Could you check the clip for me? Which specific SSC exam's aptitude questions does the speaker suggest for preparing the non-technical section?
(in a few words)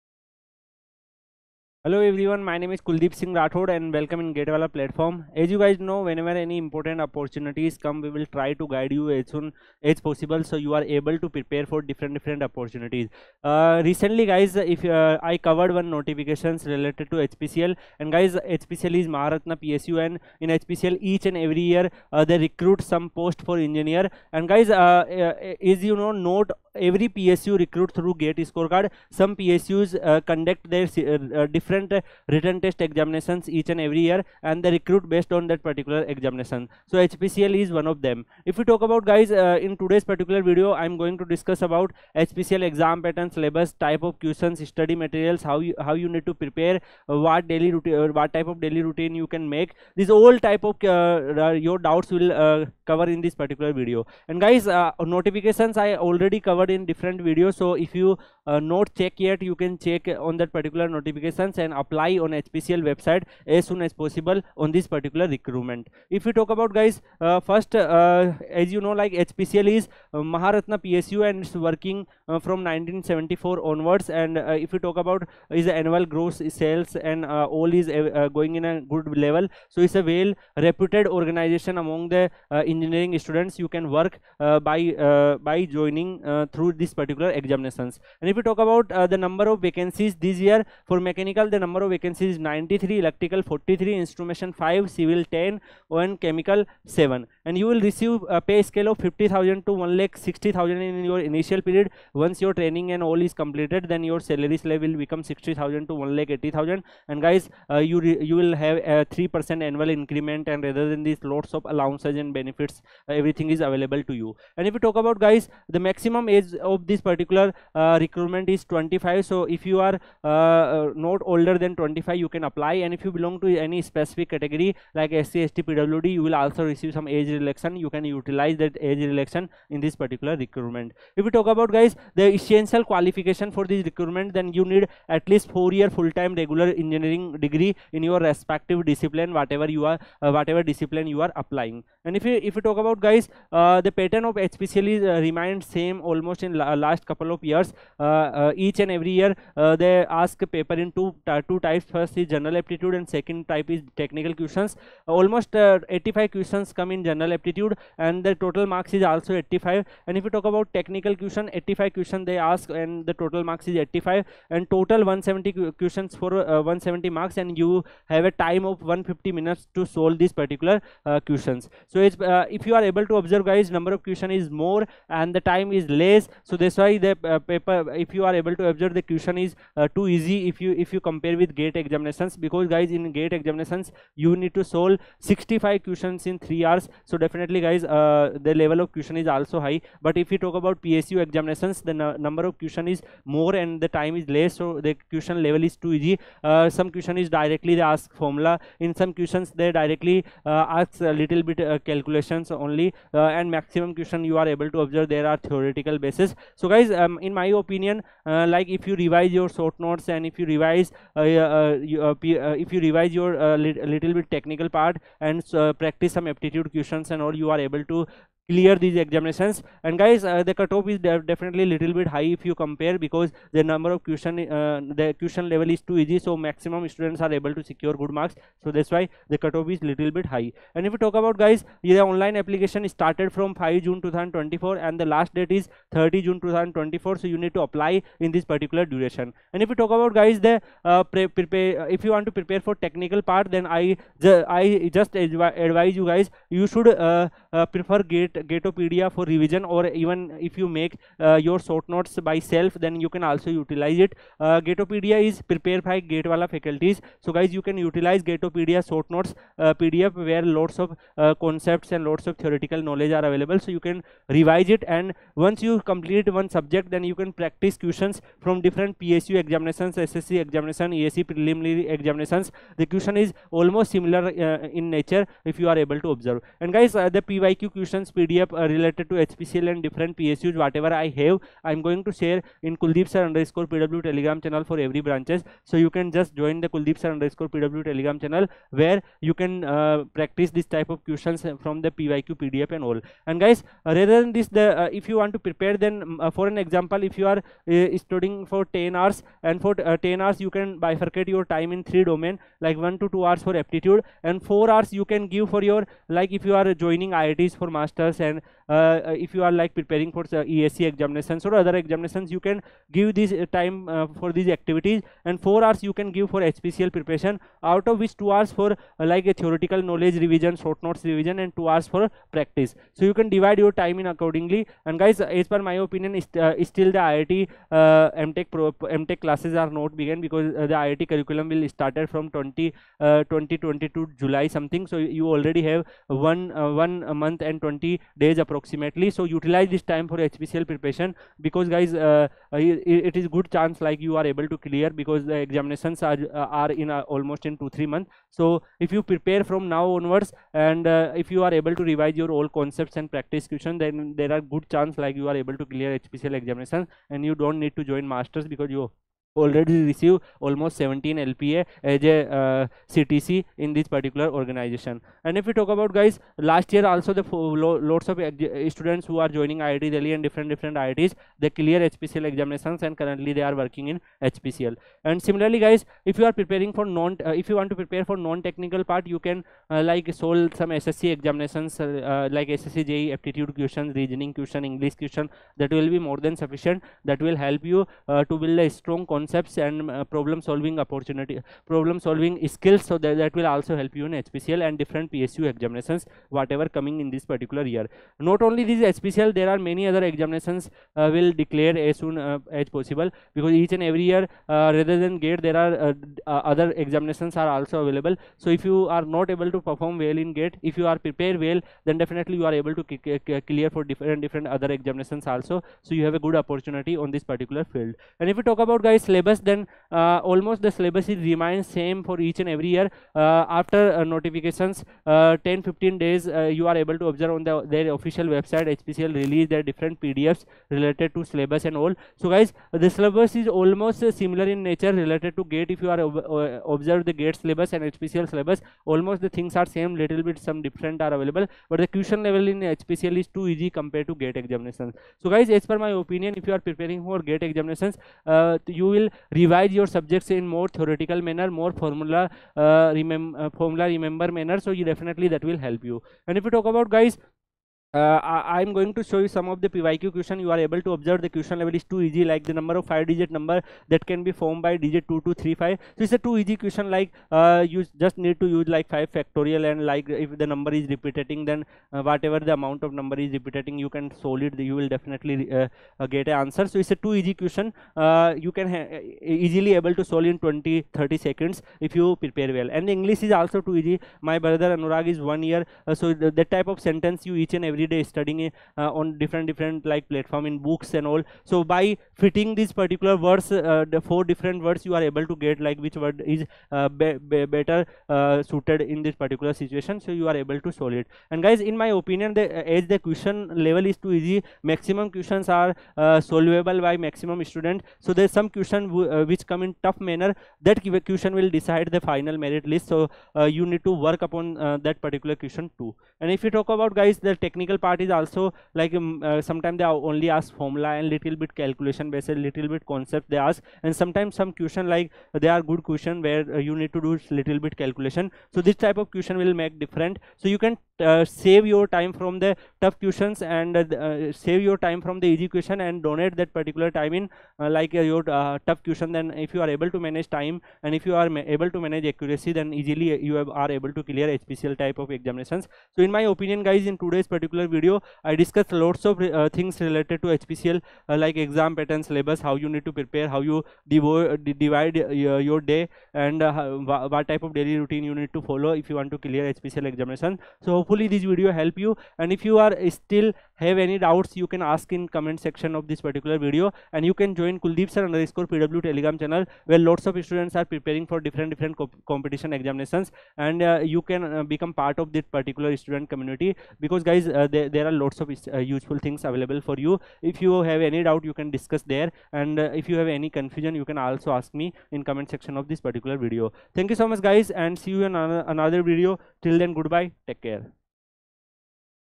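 SSC JE.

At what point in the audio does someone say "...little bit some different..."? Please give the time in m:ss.
7:20.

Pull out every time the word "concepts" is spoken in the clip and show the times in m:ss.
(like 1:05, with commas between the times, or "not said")
4:21, 5:52, 6:29, 8:42.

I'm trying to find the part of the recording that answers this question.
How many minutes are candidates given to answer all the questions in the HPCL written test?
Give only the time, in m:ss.
2:48.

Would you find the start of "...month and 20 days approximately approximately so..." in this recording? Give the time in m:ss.
5:37.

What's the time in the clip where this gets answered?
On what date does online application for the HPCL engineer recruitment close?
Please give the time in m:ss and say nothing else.
3:55.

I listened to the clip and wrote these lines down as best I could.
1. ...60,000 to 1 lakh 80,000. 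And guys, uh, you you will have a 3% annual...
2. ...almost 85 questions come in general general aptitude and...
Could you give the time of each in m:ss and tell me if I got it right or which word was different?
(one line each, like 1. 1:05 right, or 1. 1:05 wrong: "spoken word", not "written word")
1. 1:45 right
2. 2:35 right.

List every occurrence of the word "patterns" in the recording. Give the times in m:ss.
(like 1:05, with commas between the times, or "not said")
0:43, 2:23, 9:11.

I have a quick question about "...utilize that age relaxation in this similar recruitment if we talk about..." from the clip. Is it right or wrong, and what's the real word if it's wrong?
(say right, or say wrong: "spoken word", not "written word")
wrong: "particular", not "similar".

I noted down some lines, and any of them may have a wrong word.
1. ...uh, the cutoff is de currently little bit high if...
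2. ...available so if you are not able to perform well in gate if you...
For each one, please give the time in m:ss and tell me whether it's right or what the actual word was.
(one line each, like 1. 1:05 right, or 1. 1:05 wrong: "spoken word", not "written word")
1. 3:40 wrong: "definitely", not "currently"
2. 6:47 right.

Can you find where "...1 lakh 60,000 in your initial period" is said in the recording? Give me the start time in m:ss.
1:39.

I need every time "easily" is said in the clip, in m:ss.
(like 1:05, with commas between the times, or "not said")
7:59, 9:02.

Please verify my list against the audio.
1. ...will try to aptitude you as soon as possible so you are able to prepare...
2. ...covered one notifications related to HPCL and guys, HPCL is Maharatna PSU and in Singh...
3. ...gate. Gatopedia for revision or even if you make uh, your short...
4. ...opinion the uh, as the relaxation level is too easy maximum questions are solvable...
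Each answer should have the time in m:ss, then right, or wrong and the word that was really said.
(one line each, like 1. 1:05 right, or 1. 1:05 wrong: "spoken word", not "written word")
1. 0:08 wrong: "guide", not "aptitude"
2. 0:15 wrong: "HPCL", not "Singh"
3. 4:08 right
4. 8:22 wrong: "question", not "relaxation".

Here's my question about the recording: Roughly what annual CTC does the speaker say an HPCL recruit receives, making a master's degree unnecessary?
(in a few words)
17 LPA.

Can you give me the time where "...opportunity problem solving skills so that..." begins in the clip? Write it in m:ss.
6:30.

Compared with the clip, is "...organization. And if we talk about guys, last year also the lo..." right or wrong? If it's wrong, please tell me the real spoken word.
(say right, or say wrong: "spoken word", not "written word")
right.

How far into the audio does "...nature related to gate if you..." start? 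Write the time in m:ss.
7:14.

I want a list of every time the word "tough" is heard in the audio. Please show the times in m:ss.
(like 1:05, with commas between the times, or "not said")
8:29, 8:52, 8:58.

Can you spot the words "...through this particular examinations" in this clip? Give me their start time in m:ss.
1:26.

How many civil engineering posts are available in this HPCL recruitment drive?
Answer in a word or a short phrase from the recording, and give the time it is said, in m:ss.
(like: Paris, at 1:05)
10, at 1:34.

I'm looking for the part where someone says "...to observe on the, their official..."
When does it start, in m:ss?
7:07.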